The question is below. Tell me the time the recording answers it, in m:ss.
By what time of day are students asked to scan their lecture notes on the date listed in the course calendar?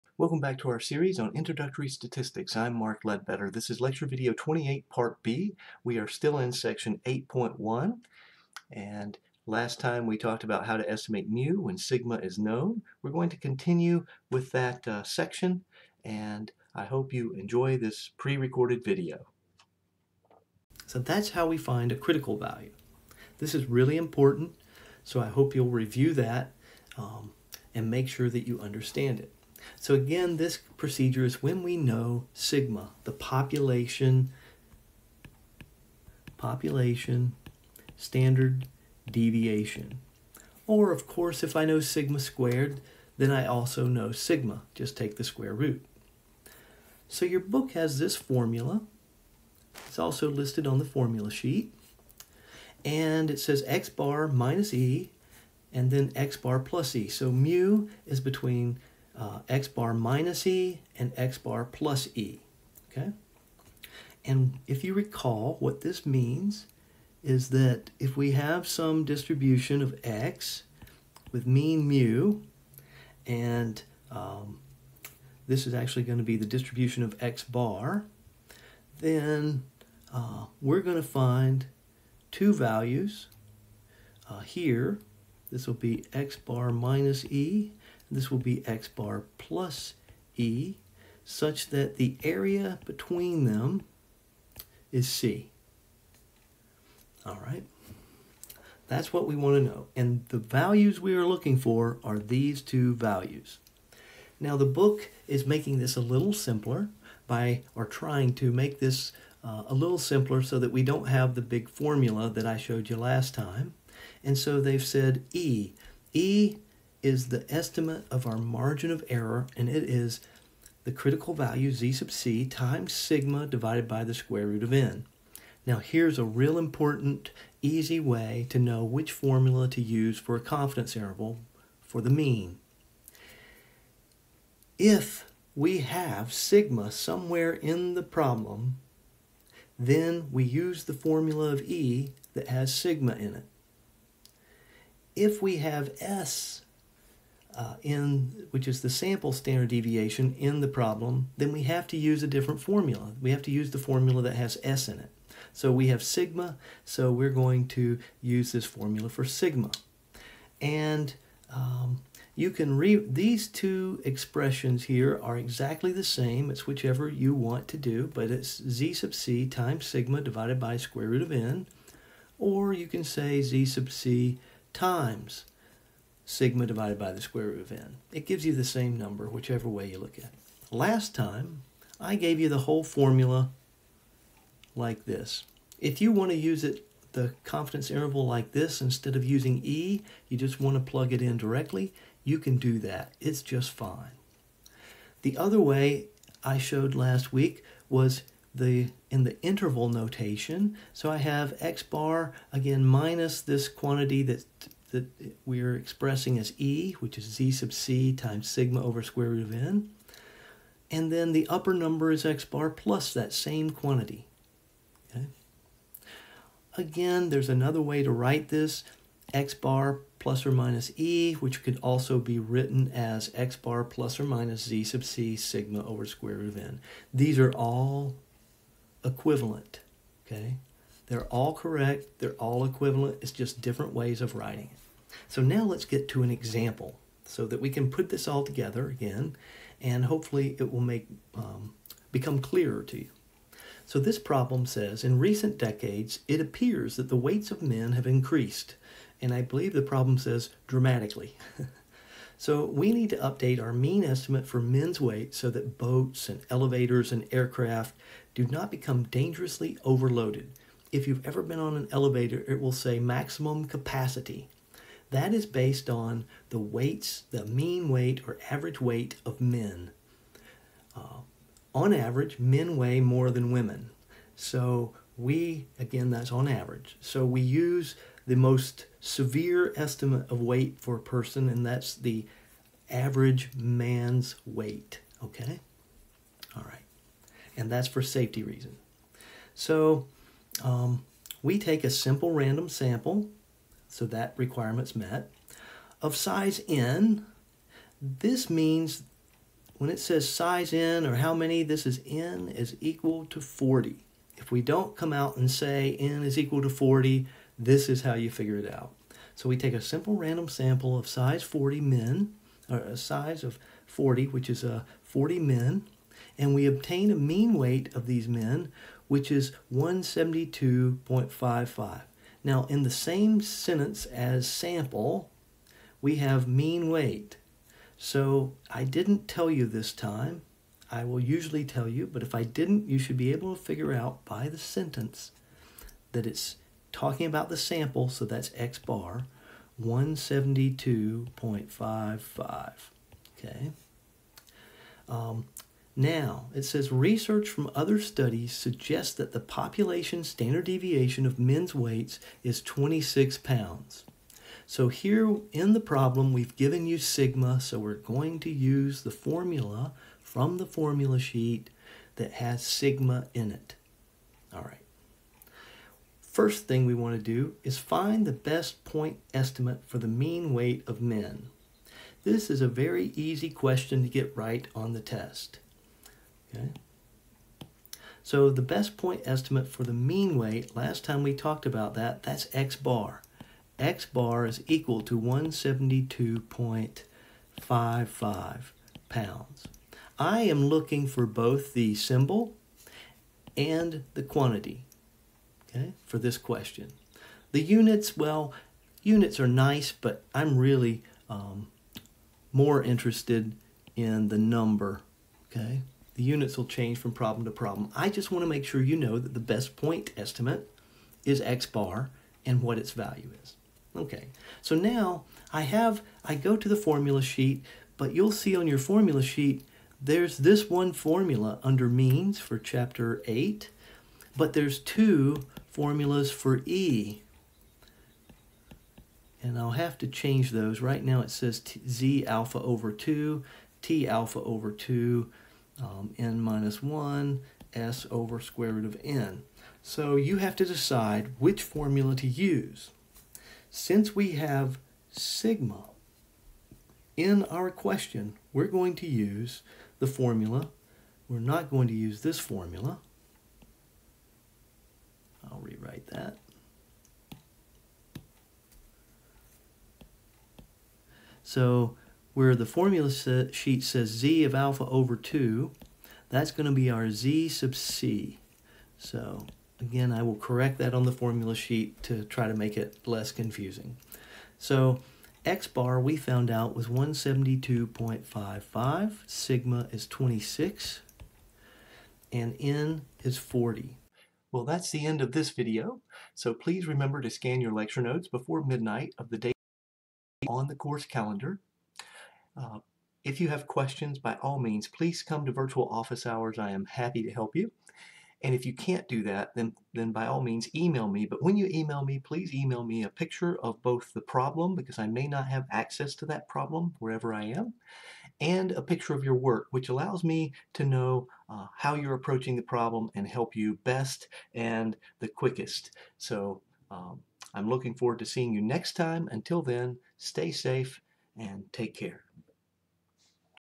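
8:08.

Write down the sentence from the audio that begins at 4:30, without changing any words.
Uh, on average, men weigh more than women.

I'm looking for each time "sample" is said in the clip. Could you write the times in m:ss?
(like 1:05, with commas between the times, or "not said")
2:28, 4:52, 5:10, 5:24, 5:37.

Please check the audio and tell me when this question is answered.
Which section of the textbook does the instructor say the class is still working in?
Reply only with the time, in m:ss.
0:07.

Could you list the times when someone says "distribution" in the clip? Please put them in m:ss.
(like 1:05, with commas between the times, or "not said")
1:09, 1:16.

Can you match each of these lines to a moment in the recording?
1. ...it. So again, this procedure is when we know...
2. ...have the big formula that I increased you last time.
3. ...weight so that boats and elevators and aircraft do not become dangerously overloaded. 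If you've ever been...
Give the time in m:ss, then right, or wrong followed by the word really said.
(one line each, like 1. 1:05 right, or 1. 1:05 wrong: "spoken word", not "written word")
1. 0:29 right
2. 1:51 wrong: "showed", not "increased"
3. 4:15 right.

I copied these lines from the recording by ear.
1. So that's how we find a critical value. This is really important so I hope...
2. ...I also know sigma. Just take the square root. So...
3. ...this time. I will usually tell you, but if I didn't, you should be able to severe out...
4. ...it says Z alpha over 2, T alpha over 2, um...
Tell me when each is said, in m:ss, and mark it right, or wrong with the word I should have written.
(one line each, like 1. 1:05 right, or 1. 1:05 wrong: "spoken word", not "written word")
1. 0:20 right
2. 0:43 right
3. 5:29 wrong: "figure", not "severe"
4. 7:11 right.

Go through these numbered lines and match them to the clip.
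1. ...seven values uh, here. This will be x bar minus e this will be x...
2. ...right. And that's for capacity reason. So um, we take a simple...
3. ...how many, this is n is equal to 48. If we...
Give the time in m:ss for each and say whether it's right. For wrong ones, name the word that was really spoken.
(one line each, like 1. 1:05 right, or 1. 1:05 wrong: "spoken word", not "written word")
1. 1:22 wrong: "two", not "seven"
2. 4:46 wrong: "safety", not "capacity"
3. 5:01 wrong: "40", not "48".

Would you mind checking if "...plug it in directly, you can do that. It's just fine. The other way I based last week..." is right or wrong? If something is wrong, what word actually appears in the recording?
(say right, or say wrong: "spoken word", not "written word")
wrong: "showed", not "based".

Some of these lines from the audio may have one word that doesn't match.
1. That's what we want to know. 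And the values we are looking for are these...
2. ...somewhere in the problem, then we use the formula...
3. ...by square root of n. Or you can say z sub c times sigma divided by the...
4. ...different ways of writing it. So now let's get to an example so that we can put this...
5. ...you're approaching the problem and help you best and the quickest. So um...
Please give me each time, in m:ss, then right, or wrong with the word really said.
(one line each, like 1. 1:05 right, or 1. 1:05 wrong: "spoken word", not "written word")
1. 1:38 right
2. 2:16 right
3. 2:50 right
4. 3:53 right
5. 8:31 right.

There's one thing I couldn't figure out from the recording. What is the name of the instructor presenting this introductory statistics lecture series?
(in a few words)
Mark Ledbetter.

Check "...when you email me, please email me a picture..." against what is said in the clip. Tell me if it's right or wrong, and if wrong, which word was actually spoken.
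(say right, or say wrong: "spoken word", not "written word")
right.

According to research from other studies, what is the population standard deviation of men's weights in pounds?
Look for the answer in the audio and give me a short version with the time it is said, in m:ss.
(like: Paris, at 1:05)
26, at 5:52.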